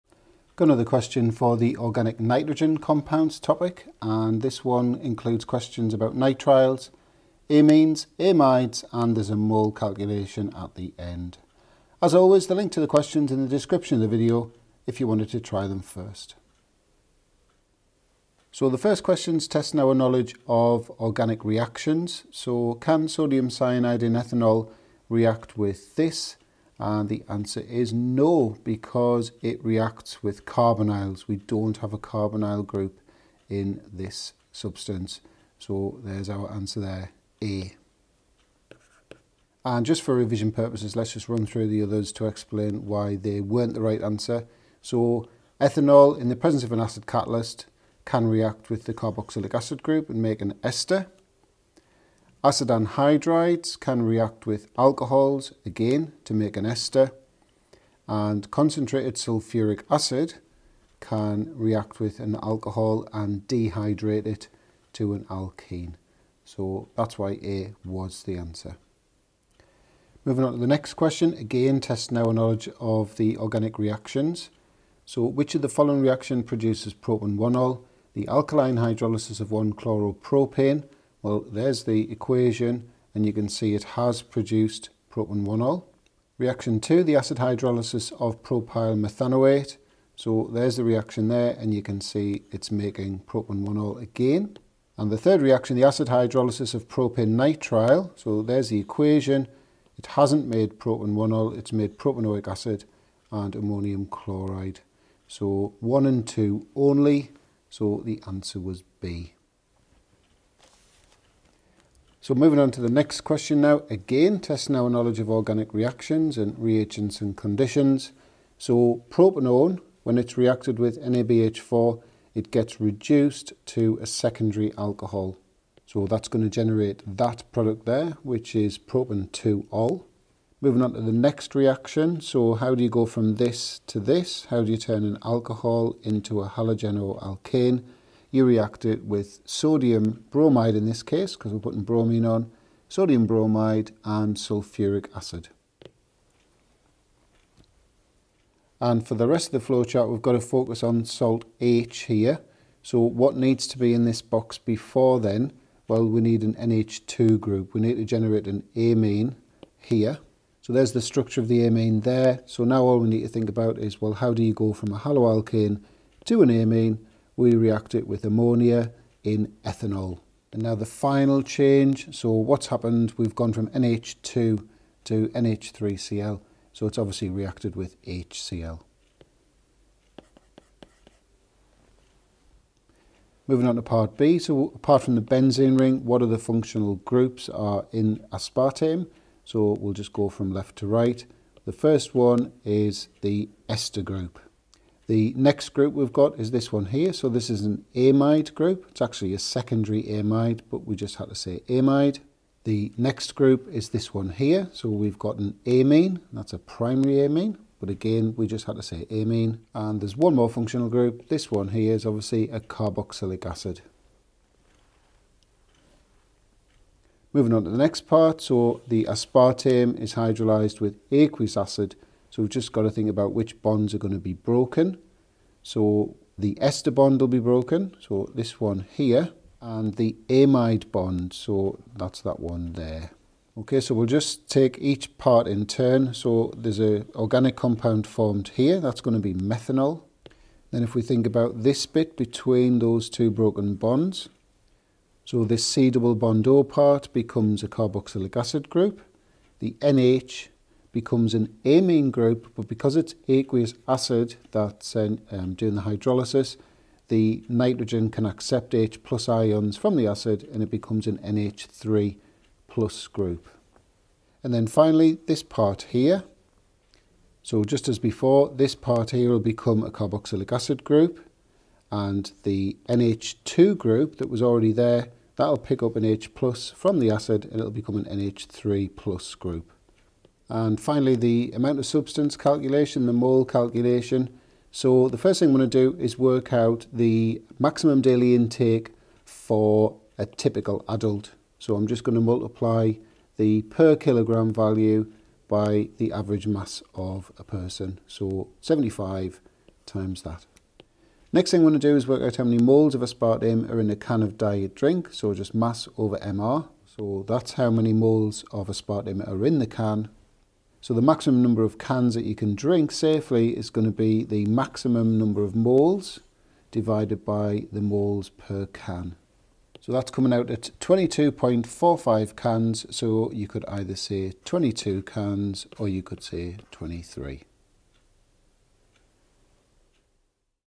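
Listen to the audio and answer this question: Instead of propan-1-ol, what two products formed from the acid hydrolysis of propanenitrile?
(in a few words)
propanoic acid and ammonium chloride.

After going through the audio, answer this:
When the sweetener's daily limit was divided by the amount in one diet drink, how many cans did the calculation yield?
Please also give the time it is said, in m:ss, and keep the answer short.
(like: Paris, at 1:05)
22.45, at 5:20.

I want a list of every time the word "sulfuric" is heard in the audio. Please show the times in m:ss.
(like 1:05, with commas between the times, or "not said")
0:59, 2:24.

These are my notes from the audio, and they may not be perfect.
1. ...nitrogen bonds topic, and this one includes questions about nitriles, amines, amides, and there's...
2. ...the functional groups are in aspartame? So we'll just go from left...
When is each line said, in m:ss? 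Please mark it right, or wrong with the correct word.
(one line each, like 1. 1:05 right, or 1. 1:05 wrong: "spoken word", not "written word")
1. 0:02 wrong: "compounds", not "bonds"
2. 3:06 right.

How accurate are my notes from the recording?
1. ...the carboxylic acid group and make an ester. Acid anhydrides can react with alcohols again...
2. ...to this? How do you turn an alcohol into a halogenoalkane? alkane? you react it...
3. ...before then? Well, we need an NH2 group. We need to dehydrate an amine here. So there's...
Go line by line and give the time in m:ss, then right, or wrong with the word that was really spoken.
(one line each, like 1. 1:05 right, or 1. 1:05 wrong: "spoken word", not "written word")
1. 0:48 right
2. 2:13 right
3. 2:34 wrong: "generate", not "dehydrate".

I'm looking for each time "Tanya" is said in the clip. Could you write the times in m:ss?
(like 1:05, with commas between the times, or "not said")
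not said.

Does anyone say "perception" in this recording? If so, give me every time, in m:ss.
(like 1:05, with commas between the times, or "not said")
not said.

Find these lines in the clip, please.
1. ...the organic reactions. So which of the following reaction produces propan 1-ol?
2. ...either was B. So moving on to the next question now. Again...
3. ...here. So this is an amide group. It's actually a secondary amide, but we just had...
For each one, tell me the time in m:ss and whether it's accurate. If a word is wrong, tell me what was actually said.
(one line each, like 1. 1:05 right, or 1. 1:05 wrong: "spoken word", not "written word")
1. 1:13 right
2. 1:48 wrong: "answer", not "either"
3. 3:16 right.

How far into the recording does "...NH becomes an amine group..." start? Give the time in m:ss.
4:09.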